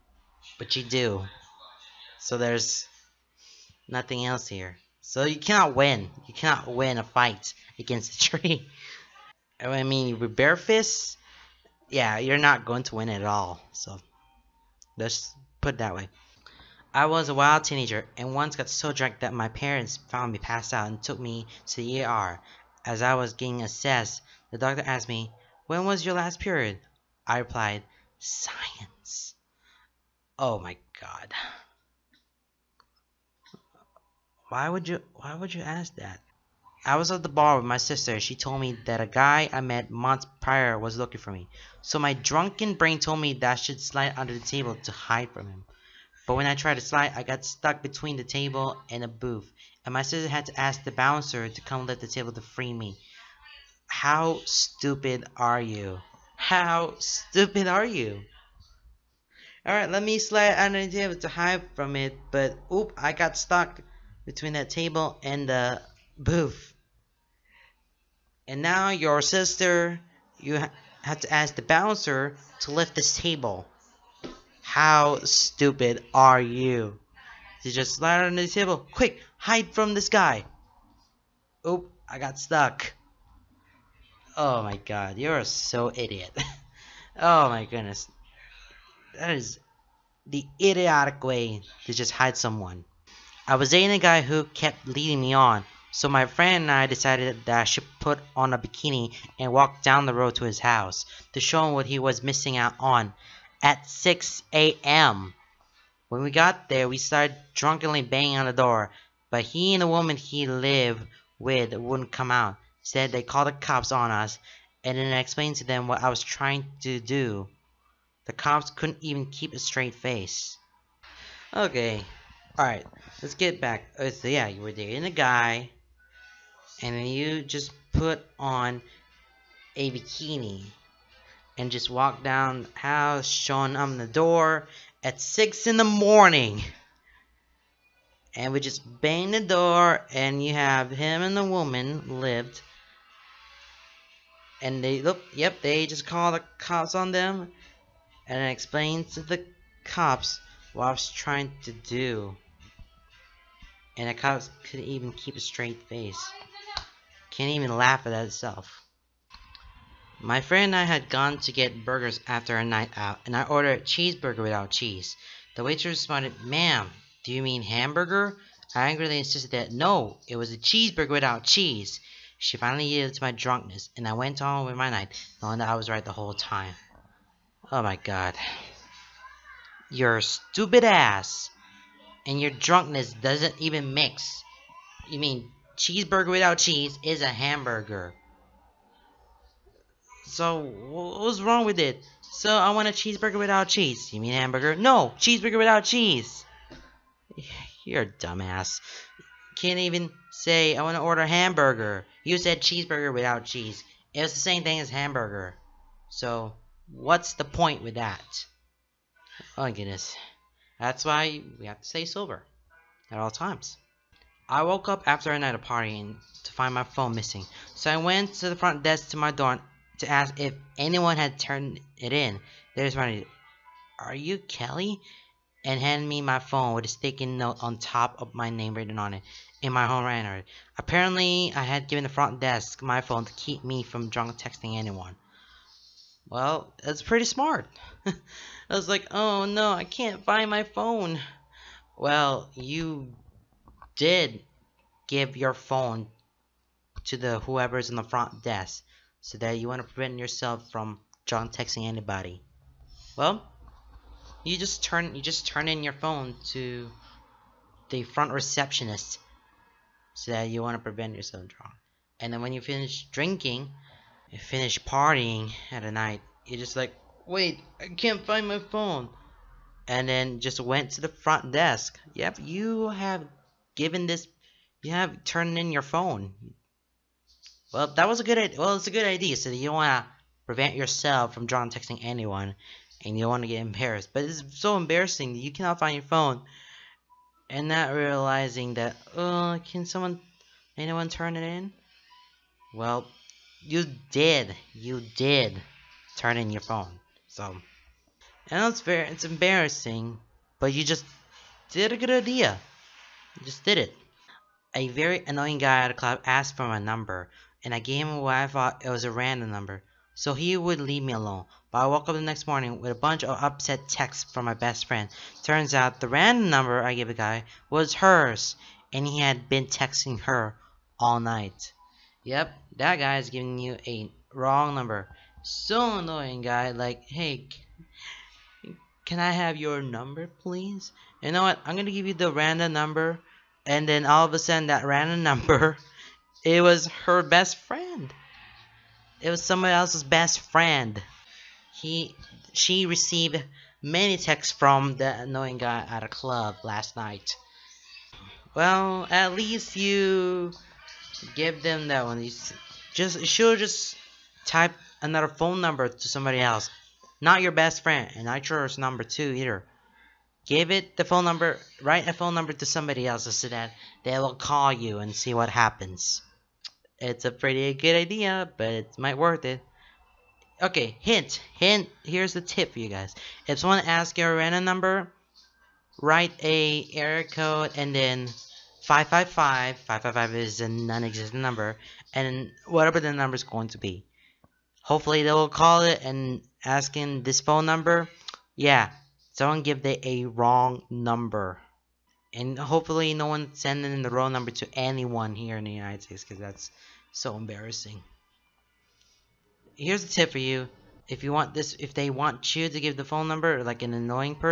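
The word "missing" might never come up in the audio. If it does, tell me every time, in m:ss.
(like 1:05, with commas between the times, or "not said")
1:42, 3:37.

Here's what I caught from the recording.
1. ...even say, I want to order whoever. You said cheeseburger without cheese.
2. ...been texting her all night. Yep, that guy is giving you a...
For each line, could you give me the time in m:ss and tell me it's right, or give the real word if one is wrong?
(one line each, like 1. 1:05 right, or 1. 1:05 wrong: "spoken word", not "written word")
1. 3:19 wrong: "hamburger", not "whoever"
2. 5:19 right.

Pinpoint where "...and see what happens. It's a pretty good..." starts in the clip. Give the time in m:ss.
6:04.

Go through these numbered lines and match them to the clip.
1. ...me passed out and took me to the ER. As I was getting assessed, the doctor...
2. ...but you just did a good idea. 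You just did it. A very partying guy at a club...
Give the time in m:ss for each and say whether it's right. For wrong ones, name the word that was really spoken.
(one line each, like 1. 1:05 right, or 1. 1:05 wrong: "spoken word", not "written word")
1. 0:20 right
2. 5:00 wrong: "annoying", not "partying".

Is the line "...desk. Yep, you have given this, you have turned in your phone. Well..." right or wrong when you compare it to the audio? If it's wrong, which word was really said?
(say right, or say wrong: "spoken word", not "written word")
right.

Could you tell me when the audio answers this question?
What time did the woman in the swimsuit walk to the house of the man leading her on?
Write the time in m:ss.
1:43.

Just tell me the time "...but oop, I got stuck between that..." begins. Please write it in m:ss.
1:02.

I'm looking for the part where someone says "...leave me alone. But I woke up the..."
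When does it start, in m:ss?
5:10.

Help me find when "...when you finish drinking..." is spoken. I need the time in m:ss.
4:22.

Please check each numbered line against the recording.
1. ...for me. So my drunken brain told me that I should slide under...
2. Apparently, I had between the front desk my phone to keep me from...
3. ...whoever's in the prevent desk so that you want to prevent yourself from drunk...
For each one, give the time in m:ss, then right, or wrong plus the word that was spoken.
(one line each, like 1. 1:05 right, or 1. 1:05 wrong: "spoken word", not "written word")
1. 0:41 right
2. 3:50 wrong: "given", not "between"
3. 4:07 wrong: "front", not "prevent".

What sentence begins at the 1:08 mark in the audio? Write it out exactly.
And now your sister, you ha have to ask the bouncer to lift this table.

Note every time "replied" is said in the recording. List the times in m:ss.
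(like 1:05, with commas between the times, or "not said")
0:27.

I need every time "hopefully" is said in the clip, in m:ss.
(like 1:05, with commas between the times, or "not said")
6:24, 6:32.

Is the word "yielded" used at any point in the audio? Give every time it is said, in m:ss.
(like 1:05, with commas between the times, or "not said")
2:52.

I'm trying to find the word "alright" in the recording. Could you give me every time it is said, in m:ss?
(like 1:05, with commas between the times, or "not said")
0:59, 2:02.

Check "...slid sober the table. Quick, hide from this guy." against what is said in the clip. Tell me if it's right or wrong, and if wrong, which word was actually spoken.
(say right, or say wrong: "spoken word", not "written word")
wrong: "under", not "sober".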